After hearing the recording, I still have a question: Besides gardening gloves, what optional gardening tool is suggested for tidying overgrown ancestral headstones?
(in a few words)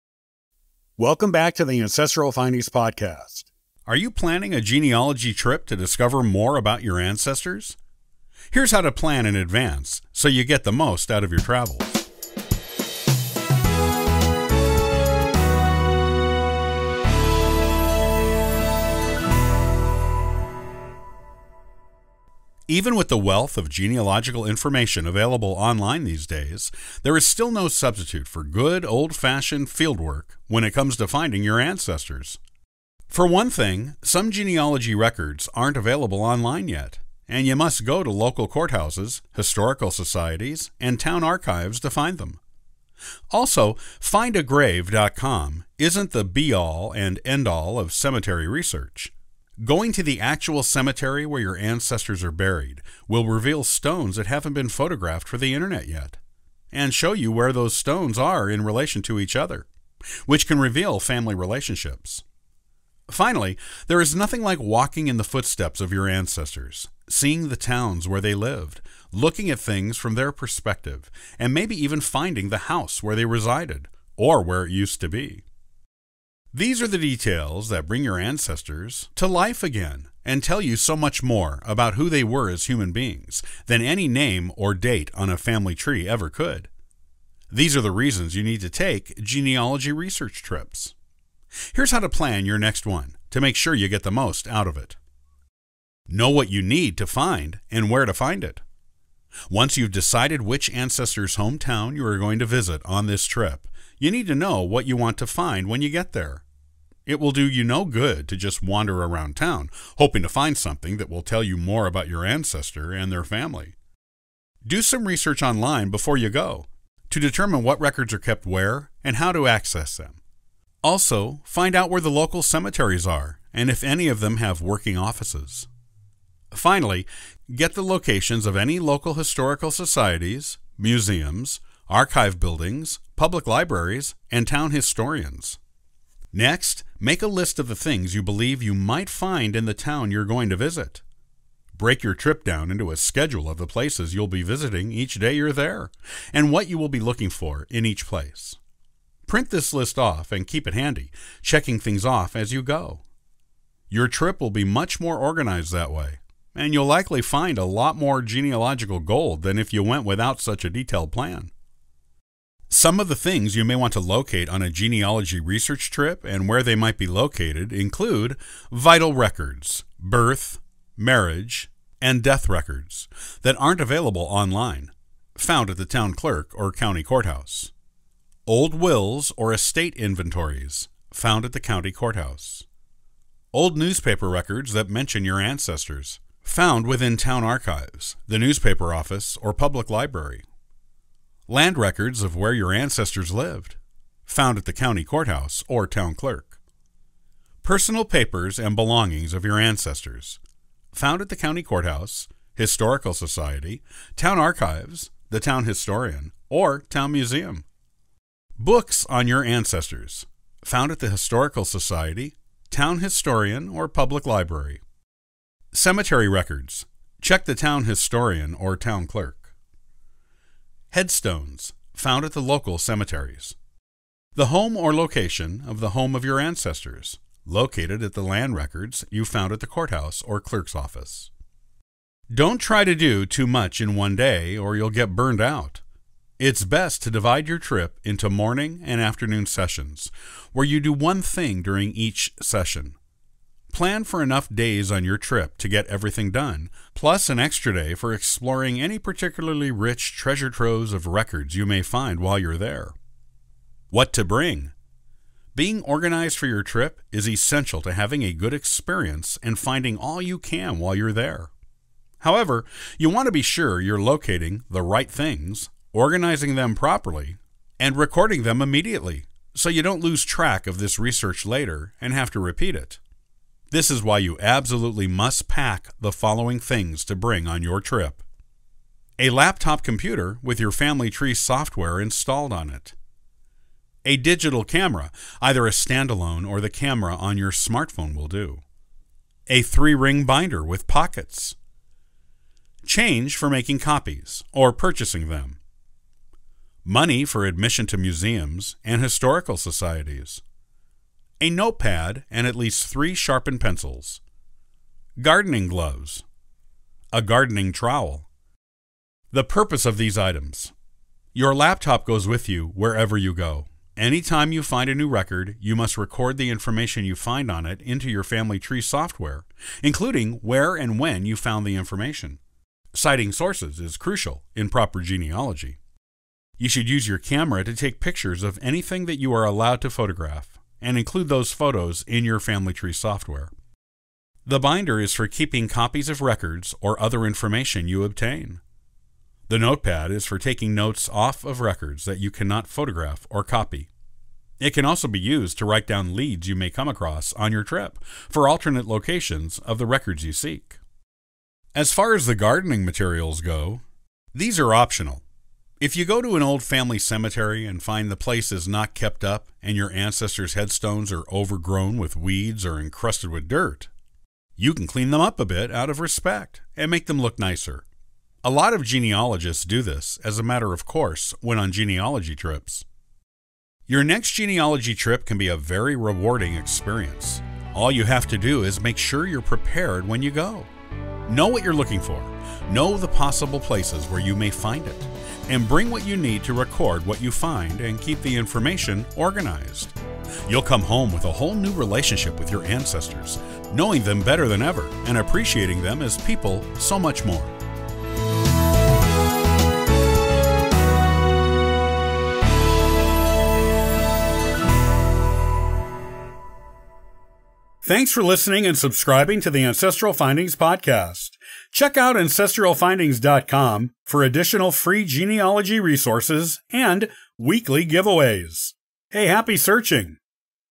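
Gardening trowel.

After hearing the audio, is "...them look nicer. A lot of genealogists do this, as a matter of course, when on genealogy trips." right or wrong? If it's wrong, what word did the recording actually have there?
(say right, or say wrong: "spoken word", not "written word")
right.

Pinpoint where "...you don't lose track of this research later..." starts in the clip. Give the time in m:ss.
4:29.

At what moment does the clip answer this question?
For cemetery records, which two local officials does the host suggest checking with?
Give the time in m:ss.
3:37.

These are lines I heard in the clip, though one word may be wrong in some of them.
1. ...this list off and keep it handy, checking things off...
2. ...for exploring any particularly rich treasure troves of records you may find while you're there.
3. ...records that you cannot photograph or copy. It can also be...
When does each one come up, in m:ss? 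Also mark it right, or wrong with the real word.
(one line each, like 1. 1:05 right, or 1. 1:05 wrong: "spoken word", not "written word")
1. 2:29 right
2. 4:07 right
3. 5:41 right.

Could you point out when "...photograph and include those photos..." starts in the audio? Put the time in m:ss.
5:29.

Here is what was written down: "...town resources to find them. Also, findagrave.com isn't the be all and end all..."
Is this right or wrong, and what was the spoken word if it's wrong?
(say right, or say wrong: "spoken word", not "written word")
wrong: "archives", not "resources".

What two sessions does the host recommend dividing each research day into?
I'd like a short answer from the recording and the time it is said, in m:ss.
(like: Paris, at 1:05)
Morning and afternoon, at 3:58.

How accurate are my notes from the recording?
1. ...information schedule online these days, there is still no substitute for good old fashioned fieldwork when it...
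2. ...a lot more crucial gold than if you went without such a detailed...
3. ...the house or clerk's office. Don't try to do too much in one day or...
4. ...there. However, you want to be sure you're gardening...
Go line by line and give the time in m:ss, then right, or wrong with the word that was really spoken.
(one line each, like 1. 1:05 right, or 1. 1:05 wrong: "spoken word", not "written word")
1. 0:24 wrong: "available", not "schedule"
2. 2:37 wrong: "genealogical", not "crucial"
3. 3:49 wrong: "courthouse", not "house"
4. 4:21 wrong: "locating", not "gardening".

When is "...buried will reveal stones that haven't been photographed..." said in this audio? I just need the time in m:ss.
0:52.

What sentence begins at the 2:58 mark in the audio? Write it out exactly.
Old wills or estate inventories, found at the county courthouse.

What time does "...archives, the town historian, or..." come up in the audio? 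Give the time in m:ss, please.
3:24.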